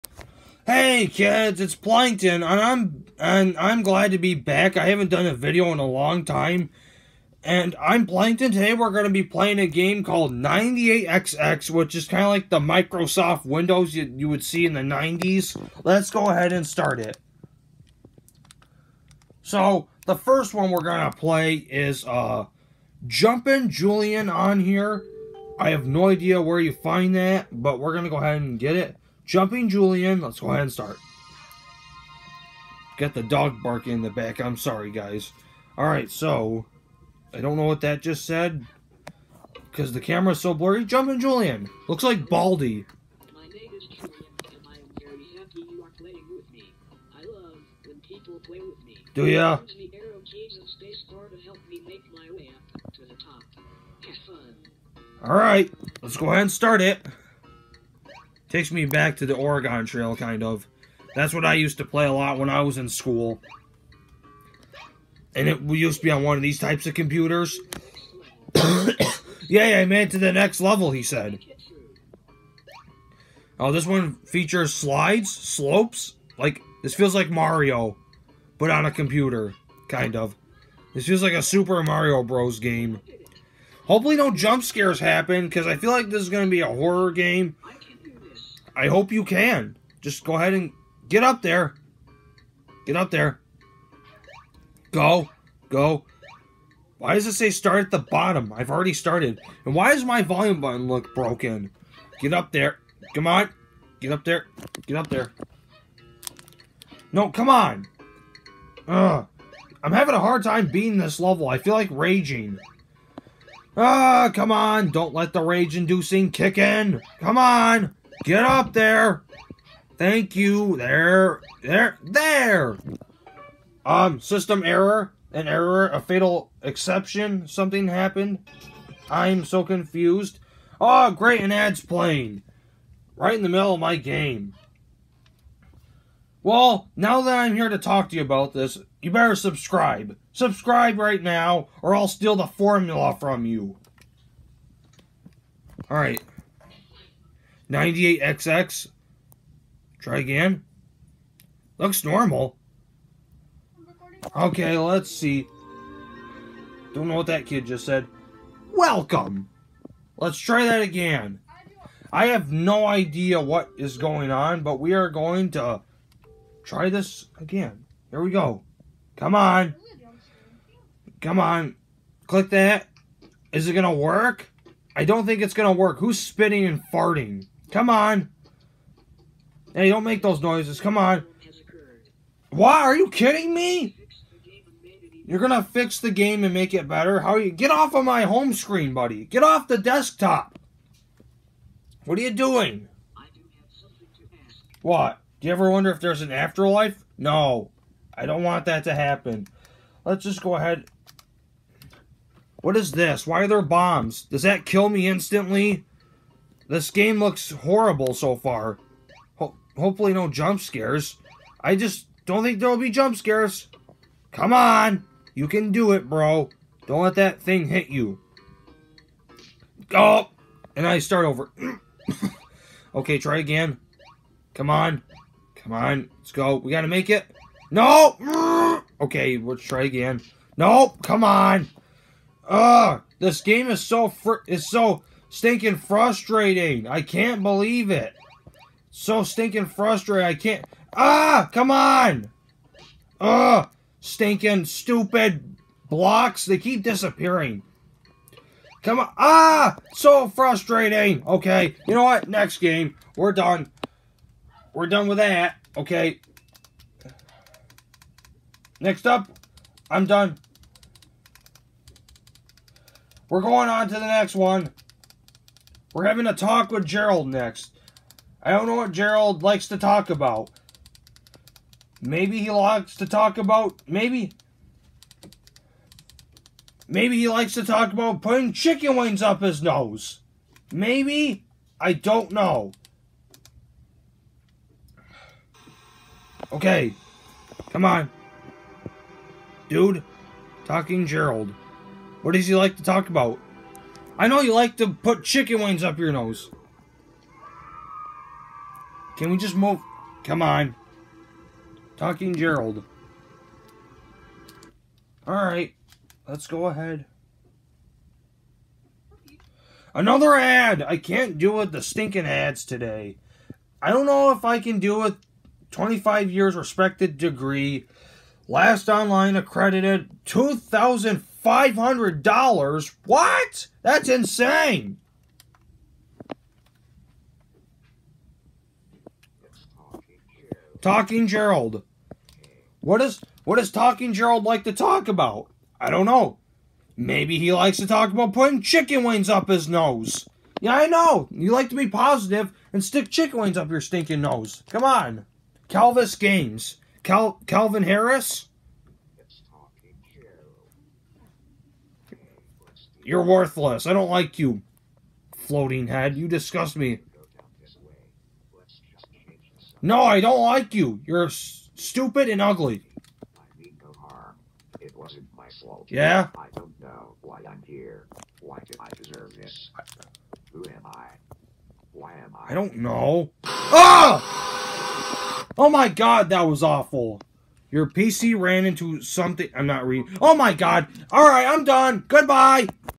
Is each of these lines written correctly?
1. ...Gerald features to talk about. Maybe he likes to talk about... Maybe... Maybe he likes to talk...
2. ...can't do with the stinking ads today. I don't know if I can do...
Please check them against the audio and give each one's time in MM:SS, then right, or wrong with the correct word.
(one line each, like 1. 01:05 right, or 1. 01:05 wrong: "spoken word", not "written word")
1. 04:28 wrong: "likes", not "features"
2. 05:10 right.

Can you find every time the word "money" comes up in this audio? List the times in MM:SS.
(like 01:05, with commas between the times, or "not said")
not said.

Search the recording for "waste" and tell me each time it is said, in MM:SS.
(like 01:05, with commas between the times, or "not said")
not said.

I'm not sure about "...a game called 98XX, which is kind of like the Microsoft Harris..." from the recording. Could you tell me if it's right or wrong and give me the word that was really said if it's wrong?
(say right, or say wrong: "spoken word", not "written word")
wrong: "Windows", not "Harris".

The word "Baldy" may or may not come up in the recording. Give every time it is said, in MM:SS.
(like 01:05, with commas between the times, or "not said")
00:42.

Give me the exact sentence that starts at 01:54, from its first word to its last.
Don't let the rage-inducing kick in.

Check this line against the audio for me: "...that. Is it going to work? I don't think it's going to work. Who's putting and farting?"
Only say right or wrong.
wrong.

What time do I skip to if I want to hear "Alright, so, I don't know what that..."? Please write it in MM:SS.
00:35.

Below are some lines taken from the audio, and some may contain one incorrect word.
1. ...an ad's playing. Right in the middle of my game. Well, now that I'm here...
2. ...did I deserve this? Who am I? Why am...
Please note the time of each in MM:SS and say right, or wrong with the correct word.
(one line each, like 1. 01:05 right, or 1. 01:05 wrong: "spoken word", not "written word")
1. 02:11 right
2. 06:08 right.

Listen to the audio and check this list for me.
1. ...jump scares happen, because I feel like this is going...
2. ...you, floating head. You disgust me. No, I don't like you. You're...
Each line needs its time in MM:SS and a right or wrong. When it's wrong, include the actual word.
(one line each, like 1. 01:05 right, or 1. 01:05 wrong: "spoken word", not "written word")
1. 01:24 right
2. 05:54 right.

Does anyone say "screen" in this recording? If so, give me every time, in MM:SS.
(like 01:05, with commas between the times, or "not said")
03:08.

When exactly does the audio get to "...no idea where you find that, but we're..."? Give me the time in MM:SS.
00:25.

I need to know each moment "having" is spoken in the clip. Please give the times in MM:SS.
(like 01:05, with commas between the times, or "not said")
01:49, 04:26.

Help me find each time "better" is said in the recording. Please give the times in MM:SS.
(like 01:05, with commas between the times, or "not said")
02:19, 03:06.